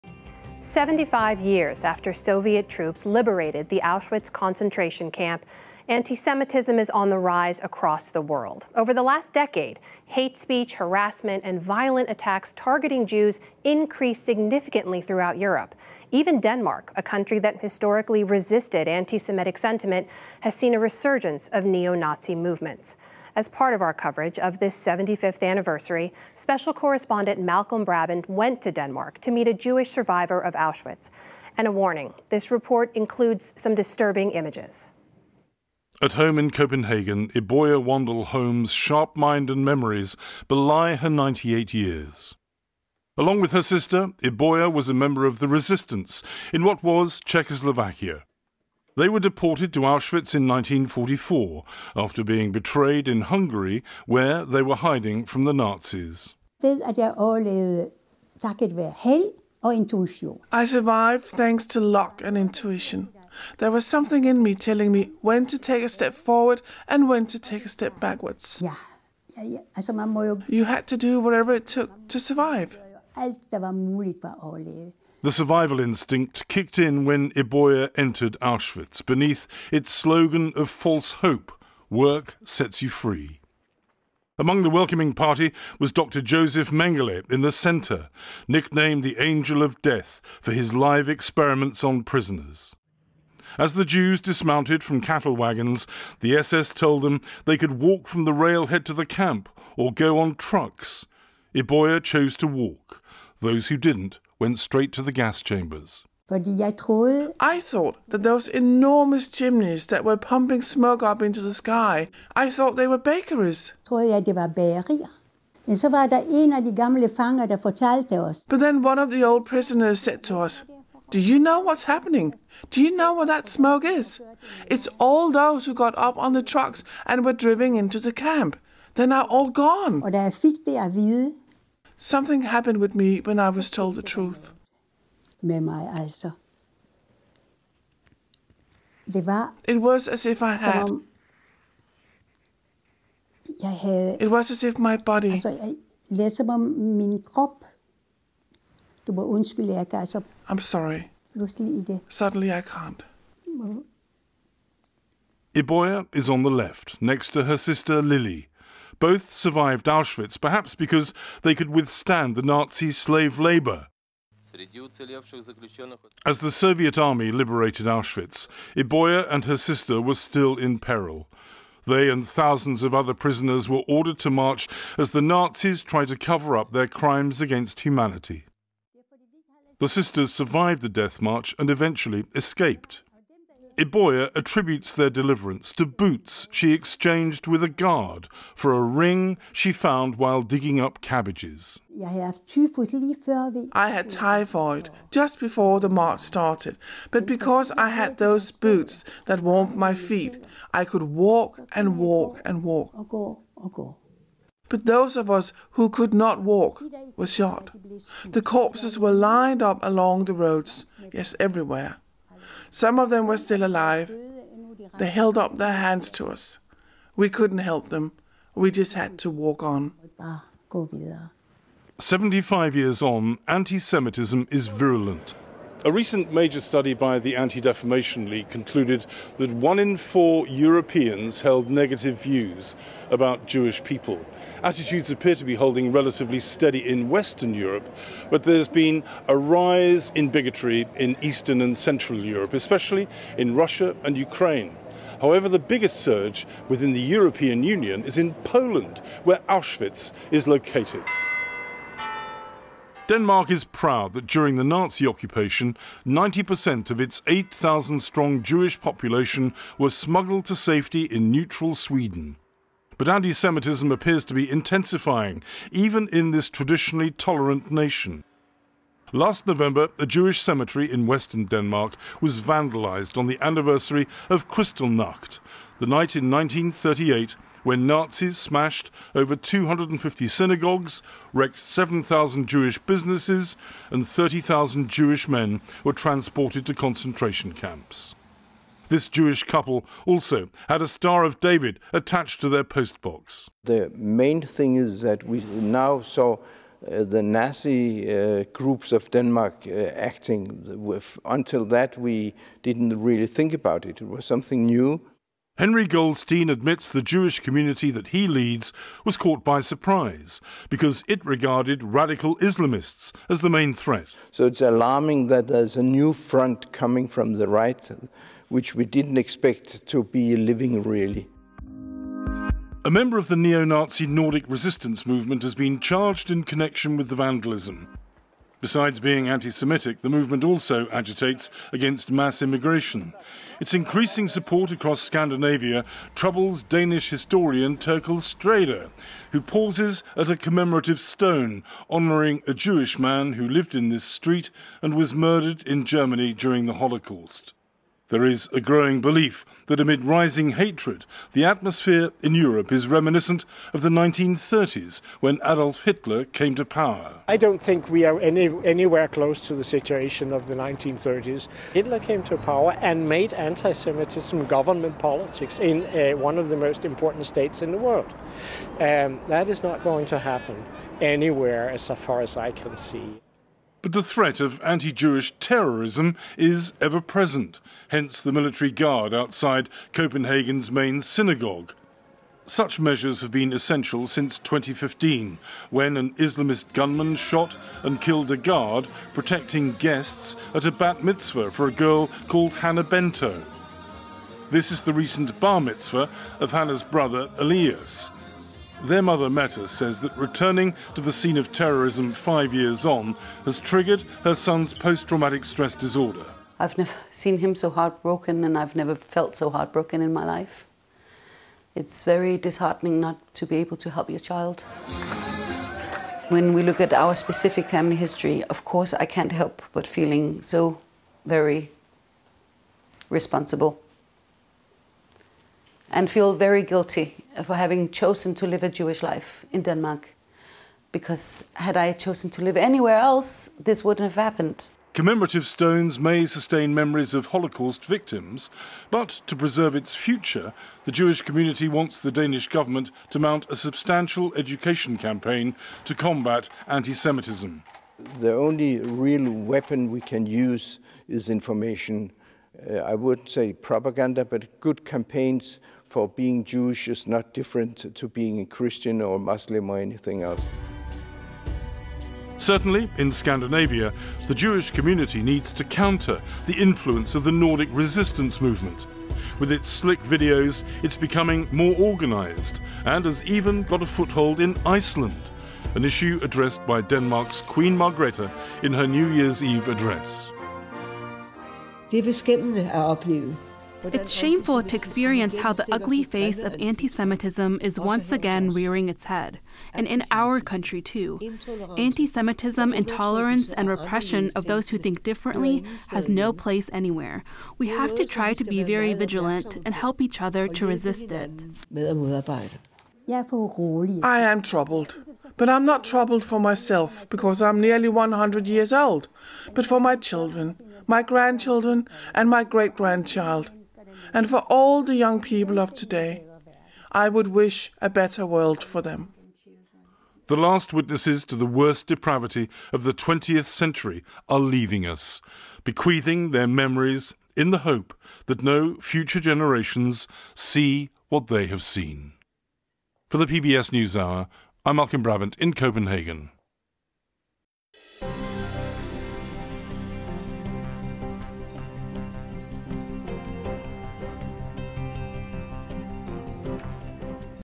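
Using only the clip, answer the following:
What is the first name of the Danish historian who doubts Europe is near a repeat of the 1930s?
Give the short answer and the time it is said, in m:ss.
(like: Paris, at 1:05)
Therkel, at 5:37.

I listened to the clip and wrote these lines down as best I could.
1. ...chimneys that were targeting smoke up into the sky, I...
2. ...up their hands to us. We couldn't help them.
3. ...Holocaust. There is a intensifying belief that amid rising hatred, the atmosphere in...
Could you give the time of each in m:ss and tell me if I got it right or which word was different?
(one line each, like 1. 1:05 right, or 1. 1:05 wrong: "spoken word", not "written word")
1. 1:49 wrong: "pumping", not "targeting"
2. 3:35 right
3. 5:46 wrong: "growing", not "intensifying".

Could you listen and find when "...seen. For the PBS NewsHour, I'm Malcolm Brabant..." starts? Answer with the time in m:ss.
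8:51.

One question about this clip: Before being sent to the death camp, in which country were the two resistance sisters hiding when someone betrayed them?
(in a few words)
Hungary.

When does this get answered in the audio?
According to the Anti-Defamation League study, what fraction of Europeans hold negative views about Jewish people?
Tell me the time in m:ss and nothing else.
3:49.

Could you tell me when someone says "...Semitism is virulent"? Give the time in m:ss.
3:43.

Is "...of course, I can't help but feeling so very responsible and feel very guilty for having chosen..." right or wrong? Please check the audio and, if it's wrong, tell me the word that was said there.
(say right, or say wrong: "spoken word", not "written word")
right.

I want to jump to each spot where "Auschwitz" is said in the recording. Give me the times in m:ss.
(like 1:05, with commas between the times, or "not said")
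0:03, 0:30, 0:49, 1:18, 2:39, 2:47, 4:09.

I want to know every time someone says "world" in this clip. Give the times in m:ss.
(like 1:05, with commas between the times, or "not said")
0:08, 6:07, 8:38.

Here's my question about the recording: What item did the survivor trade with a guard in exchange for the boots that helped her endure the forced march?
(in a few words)
A ring.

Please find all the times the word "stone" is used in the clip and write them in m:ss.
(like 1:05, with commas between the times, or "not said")
5:40, 7:15.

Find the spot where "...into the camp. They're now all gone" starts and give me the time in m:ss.
2:07.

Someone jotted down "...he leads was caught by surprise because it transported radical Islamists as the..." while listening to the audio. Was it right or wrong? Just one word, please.
wrong.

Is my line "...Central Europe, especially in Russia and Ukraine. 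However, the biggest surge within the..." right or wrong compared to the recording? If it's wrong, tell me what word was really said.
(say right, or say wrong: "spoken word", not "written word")
right.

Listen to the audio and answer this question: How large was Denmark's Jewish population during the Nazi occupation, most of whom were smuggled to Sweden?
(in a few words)
8,000.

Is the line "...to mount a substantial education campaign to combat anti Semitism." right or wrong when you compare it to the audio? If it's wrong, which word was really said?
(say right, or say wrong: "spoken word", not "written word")
right.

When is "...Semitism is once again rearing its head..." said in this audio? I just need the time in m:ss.
8:06.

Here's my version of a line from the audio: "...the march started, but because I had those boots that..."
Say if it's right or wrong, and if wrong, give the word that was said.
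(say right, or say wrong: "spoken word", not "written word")
right.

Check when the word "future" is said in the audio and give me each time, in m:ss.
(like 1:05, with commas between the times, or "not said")
7:19, 8:48.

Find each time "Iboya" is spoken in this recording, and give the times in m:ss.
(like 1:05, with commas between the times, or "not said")
0:37, 0:44, 1:17, 1:41, 2:35, 2:48, 3:03.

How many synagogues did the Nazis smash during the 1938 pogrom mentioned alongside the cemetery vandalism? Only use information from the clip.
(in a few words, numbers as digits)
Over 250.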